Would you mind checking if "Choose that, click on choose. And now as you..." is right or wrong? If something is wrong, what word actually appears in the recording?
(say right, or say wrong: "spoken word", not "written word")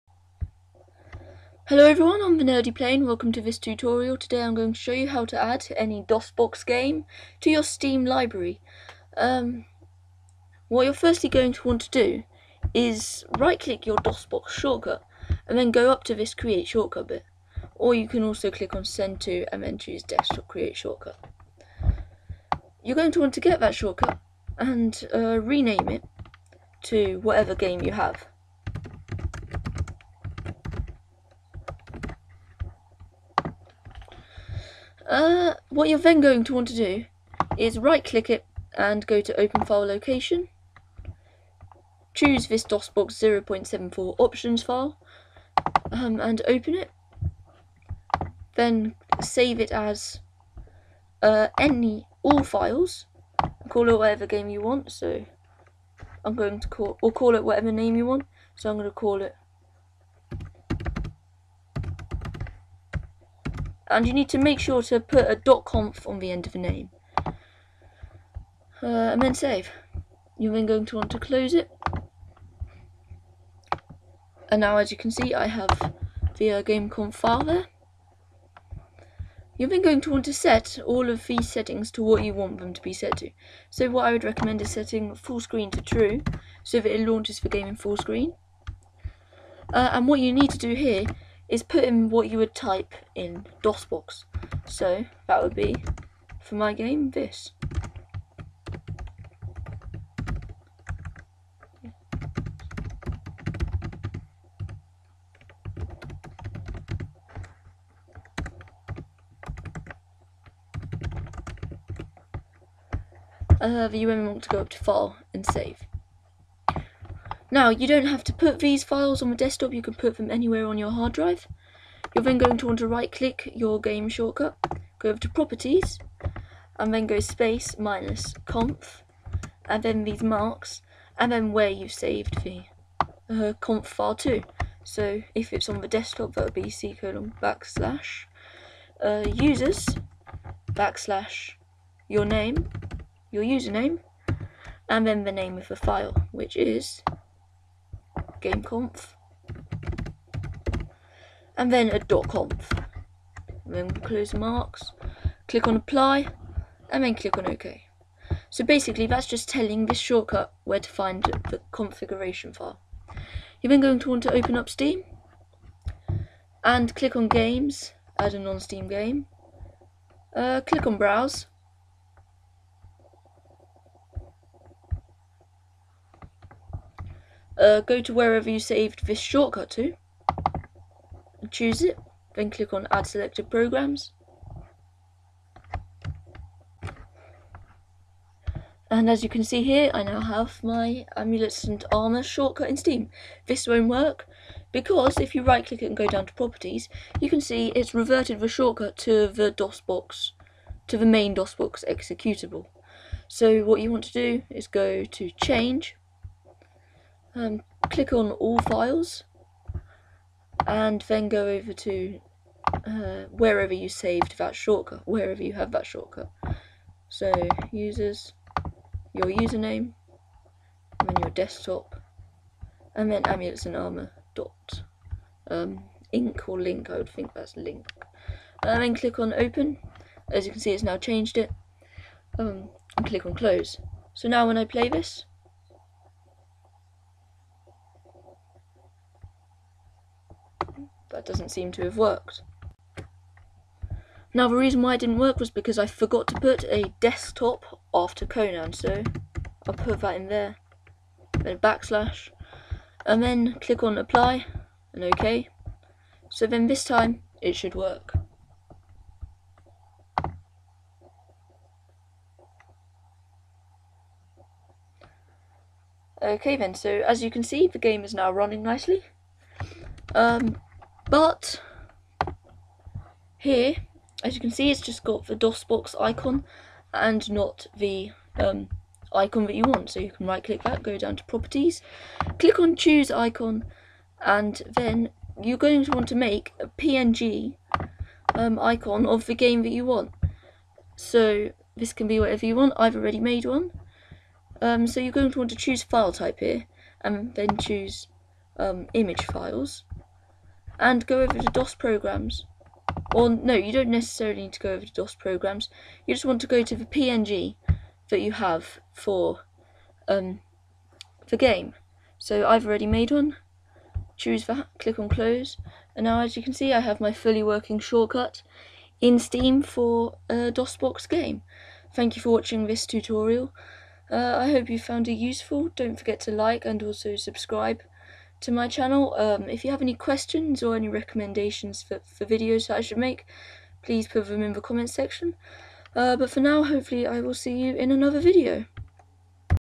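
wrong: "close", not "choose".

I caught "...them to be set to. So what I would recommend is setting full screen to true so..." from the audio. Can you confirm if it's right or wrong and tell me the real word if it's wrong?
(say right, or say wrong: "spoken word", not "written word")
right.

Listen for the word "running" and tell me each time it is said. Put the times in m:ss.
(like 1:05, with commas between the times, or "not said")
4:28.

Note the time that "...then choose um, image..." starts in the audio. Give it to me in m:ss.
4:57.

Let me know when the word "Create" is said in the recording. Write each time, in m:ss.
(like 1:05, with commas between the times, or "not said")
0:16, 0:20.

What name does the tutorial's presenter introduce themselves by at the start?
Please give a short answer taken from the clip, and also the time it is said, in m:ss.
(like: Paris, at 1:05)
Nerdy Plane, at 0:02.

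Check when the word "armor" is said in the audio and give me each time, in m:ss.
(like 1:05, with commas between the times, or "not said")
3:11, 3:43.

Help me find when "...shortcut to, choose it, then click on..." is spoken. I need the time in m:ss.
2:59.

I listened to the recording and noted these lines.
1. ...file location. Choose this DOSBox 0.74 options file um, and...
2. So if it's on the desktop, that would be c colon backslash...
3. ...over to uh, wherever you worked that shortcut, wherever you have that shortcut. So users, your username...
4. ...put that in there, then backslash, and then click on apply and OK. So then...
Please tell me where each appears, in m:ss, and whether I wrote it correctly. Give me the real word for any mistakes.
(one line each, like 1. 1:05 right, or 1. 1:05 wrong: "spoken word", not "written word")
1. 0:39 right
2. 2:14 right
3. 3:31 wrong: "saved", not "worked"
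4. 4:09 right.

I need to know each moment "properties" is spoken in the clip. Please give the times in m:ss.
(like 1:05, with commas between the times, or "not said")
2:05, 3:16, 4:41.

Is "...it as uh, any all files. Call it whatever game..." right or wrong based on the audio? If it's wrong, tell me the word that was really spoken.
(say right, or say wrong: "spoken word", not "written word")
right.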